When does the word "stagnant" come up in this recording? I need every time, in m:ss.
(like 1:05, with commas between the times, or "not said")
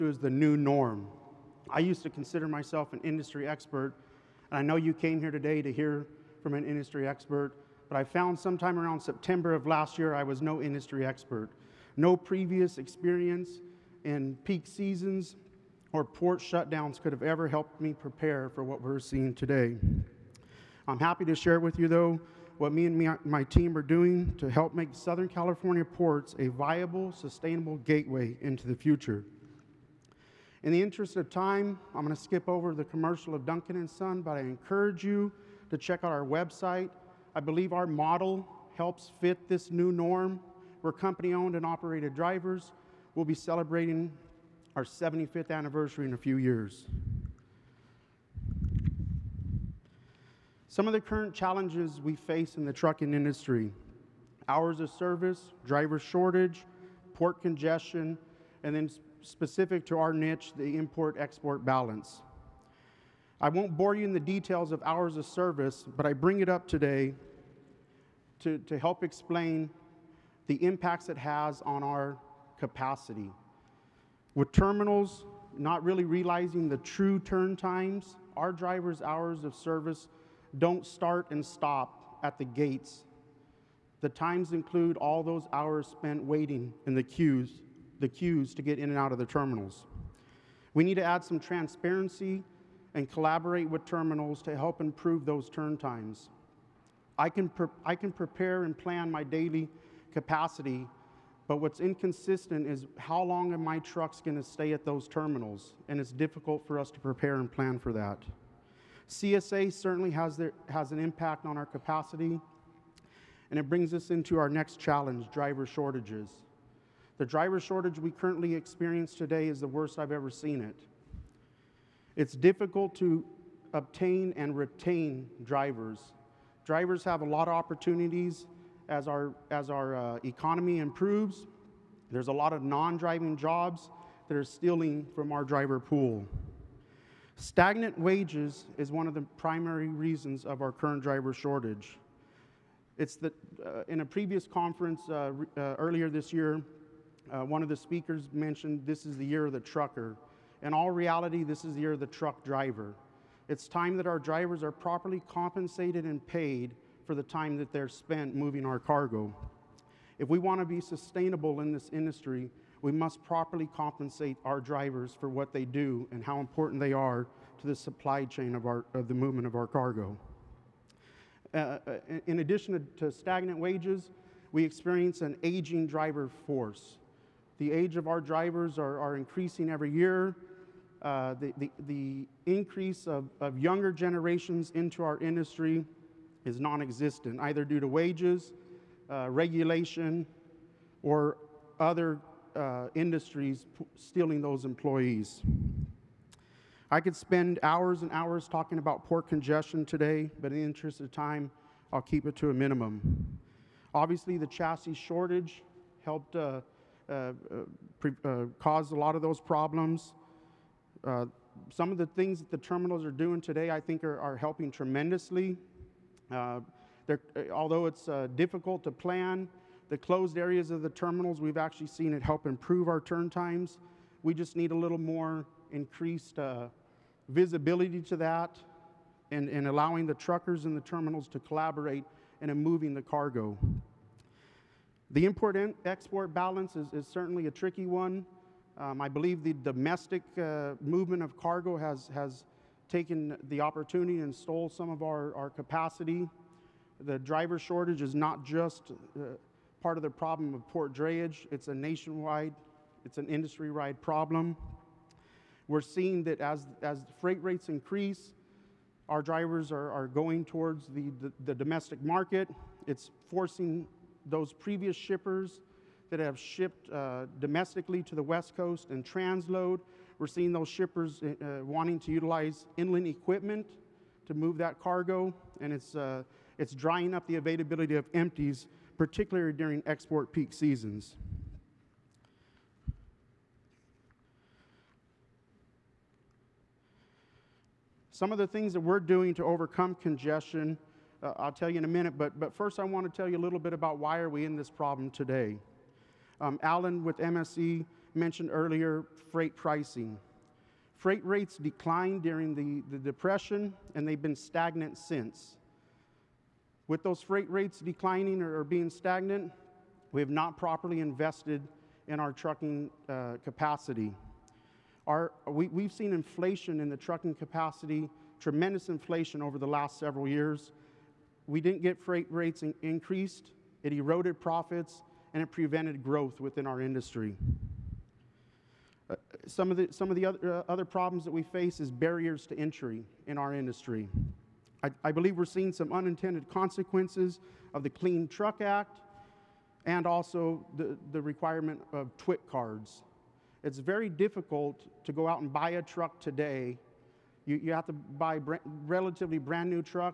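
2:17, 2:53, 5:04, 5:08.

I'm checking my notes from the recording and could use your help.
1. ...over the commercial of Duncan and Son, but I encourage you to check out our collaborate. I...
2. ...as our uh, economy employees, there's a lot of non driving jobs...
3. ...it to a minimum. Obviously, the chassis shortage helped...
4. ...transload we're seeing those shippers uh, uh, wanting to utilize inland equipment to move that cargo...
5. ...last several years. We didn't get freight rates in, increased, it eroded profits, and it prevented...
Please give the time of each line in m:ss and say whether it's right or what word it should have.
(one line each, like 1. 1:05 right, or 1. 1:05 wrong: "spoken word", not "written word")
1. 0:32 wrong: "website", not "collaborate"
2. 2:09 wrong: "improves", not "employees"
3. 3:22 right
4. 4:29 right
5. 5:19 right.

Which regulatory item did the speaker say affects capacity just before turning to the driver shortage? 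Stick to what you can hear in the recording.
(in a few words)
CSA.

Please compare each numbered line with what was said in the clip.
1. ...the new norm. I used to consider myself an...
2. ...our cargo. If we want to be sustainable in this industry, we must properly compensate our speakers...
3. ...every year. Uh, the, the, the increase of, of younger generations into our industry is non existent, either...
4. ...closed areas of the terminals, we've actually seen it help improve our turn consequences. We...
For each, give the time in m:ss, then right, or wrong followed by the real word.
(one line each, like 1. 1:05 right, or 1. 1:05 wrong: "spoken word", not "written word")
1. 0:00 right
2. 2:38 wrong: "drivers", not "speakers"
3. 2:59 right
4. 3:39 wrong: "times", not "consequences".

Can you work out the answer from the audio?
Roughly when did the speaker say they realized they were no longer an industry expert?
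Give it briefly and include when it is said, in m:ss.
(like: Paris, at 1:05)
September of last year, at 0:08.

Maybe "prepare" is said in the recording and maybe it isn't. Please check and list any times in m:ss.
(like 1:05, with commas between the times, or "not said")
0:17, 1:38, 1:47.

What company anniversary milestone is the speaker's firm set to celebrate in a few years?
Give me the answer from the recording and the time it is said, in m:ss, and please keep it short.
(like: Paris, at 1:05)
75th, at 0:44.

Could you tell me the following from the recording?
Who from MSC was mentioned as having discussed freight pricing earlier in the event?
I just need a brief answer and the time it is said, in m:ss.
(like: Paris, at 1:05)
Allen, at 4:56.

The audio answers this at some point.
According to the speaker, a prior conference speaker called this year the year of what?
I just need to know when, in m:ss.
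2:29.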